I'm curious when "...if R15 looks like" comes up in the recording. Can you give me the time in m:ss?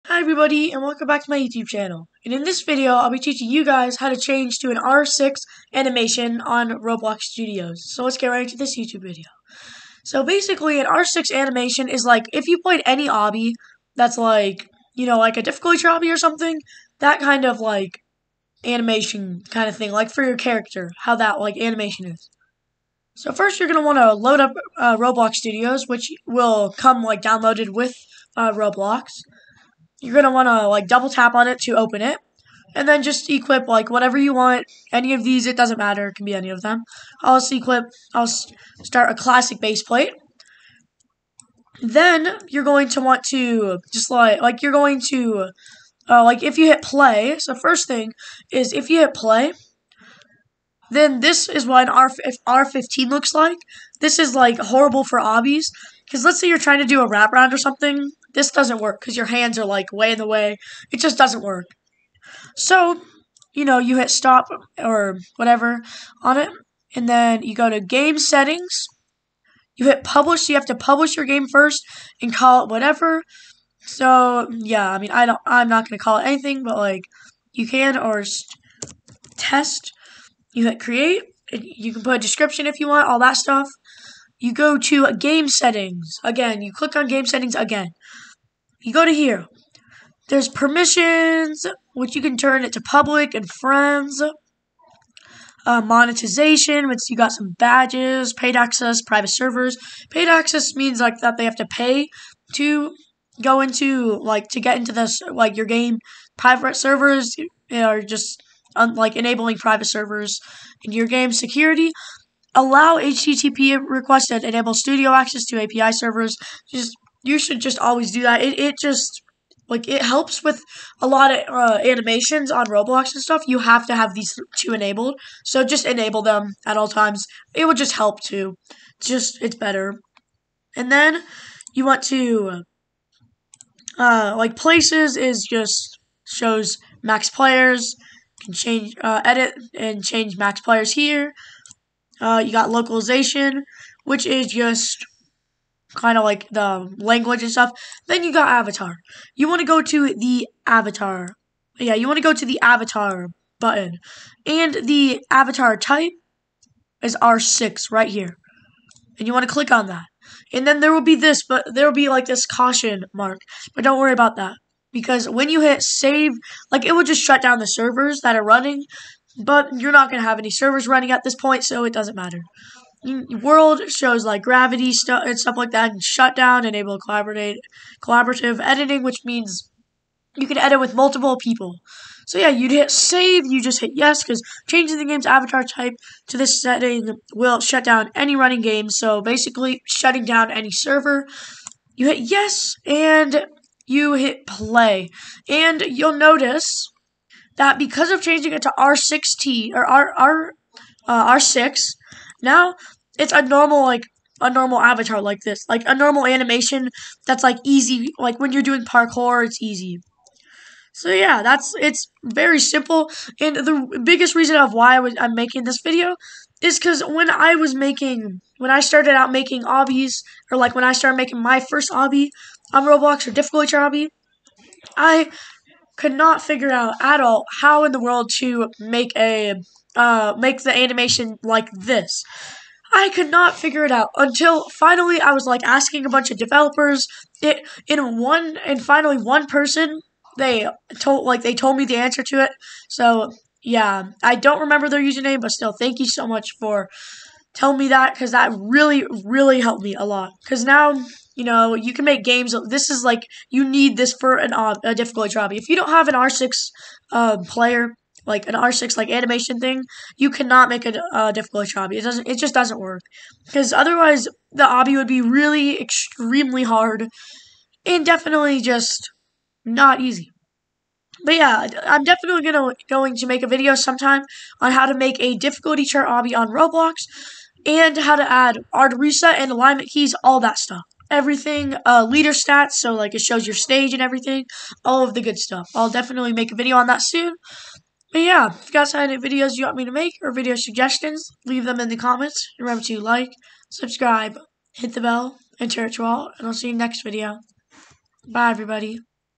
0:52.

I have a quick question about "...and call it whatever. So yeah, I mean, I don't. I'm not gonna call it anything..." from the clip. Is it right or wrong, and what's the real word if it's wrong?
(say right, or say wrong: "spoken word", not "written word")
right.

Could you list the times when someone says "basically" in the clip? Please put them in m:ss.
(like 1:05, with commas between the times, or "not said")
0:10, 3:09.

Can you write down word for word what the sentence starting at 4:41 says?
Everything, uh, leader stats, so like it shows your stage and everything, all of the good stuff.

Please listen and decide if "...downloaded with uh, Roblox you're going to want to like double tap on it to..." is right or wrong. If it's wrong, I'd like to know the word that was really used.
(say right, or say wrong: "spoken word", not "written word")
right.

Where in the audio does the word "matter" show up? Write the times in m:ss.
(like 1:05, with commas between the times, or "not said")
0:35, 2:52.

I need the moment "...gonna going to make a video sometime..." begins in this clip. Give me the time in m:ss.
4:32.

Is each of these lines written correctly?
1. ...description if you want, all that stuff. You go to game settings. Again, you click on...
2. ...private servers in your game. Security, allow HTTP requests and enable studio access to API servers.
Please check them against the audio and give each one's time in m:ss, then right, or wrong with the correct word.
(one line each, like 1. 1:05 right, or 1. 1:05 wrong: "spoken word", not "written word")
1. 1:22 right
2. 1:49 right.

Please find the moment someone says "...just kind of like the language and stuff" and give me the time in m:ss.
2:24.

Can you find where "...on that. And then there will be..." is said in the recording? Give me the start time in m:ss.
2:39.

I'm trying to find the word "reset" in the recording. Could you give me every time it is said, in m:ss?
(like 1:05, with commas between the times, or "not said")
4:38.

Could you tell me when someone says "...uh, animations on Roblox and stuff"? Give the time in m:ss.
2:01.